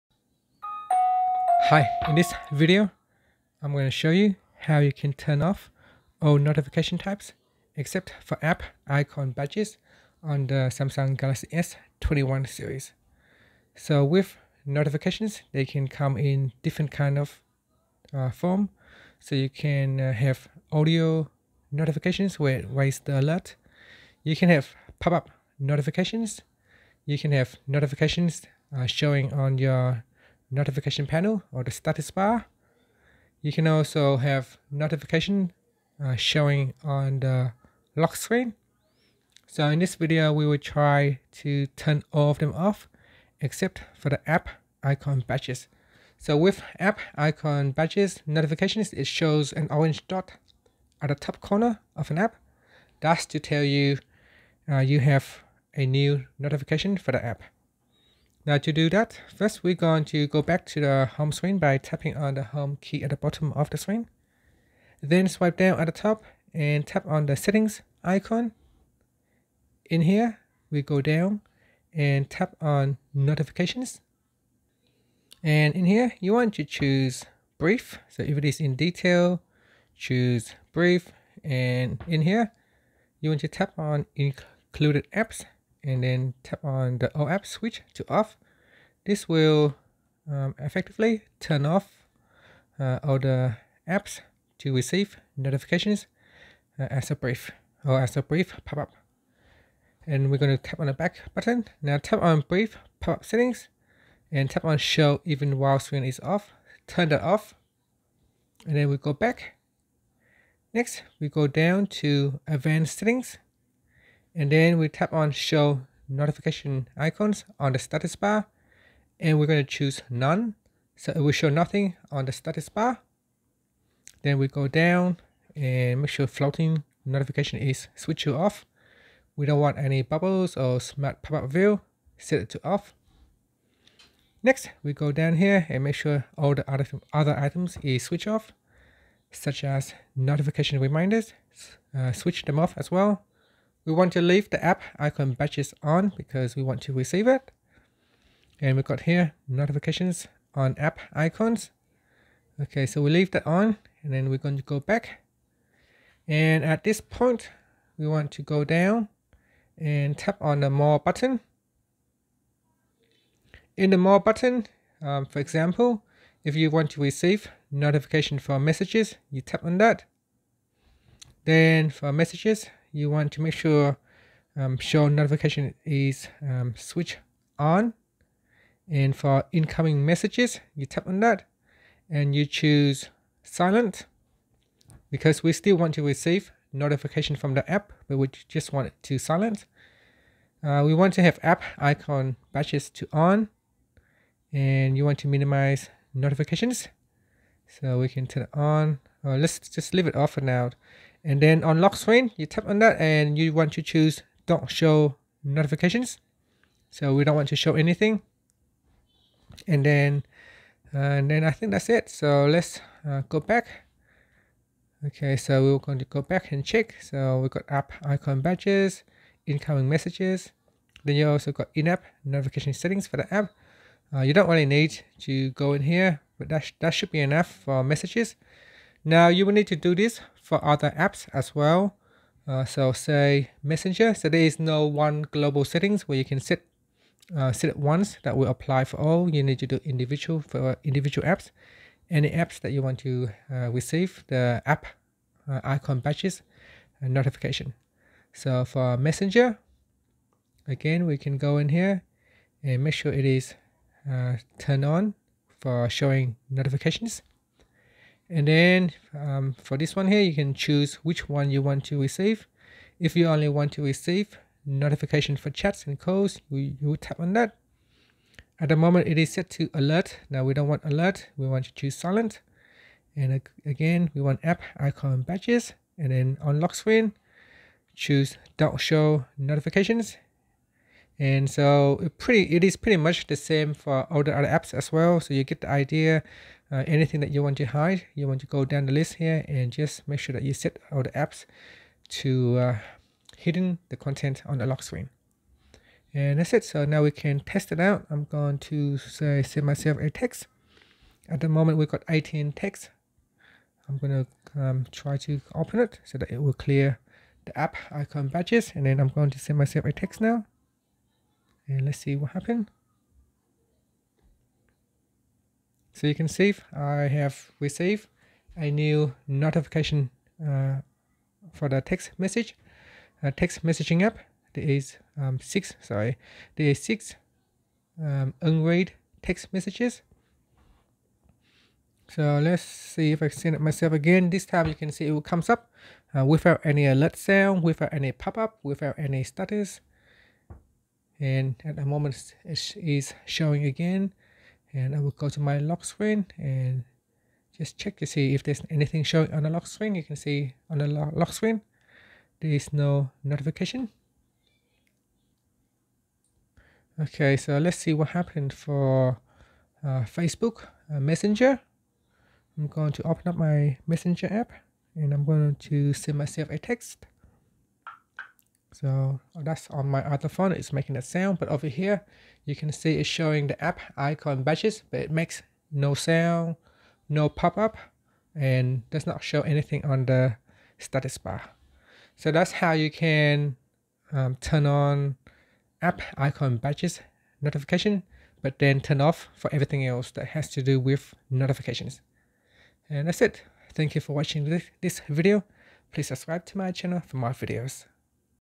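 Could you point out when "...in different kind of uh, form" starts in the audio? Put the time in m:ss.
0:16.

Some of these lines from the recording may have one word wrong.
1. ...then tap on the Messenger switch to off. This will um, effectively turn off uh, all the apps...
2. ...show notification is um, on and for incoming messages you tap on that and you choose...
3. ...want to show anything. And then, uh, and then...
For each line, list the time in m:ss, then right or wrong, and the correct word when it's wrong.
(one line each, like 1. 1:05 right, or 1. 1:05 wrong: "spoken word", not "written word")
1. 1:26 wrong: "OAuth", not "Messenger"
2. 2:54 right
3. 3:27 right.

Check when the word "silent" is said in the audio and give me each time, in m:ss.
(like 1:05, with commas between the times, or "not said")
3:03, 3:09, 4:31.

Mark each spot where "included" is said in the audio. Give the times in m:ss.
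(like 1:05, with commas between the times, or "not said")
1:24.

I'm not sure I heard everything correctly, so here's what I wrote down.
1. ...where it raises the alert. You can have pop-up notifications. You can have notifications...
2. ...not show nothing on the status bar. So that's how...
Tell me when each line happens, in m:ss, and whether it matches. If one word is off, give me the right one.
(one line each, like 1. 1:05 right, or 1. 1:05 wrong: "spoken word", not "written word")
1. 0:22 right
2. 6:19 wrong: "anything", not "nothing".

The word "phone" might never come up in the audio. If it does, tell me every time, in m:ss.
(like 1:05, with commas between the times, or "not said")
6:10.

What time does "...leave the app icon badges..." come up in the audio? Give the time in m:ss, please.
2:24.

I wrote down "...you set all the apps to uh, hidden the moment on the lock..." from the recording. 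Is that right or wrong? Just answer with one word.
wrong.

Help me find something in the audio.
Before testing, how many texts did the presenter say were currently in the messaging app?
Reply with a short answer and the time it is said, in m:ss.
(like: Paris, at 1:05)
18, at 5:02.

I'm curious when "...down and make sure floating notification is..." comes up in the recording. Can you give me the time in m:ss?
2:04.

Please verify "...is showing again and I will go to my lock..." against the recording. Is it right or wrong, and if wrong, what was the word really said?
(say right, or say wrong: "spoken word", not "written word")
right.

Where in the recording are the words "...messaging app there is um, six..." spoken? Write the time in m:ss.
5:23.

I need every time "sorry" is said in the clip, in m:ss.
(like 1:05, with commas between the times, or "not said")
5:25.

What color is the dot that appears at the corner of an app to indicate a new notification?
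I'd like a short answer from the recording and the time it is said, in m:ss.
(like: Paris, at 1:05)
Orange, at 0:49.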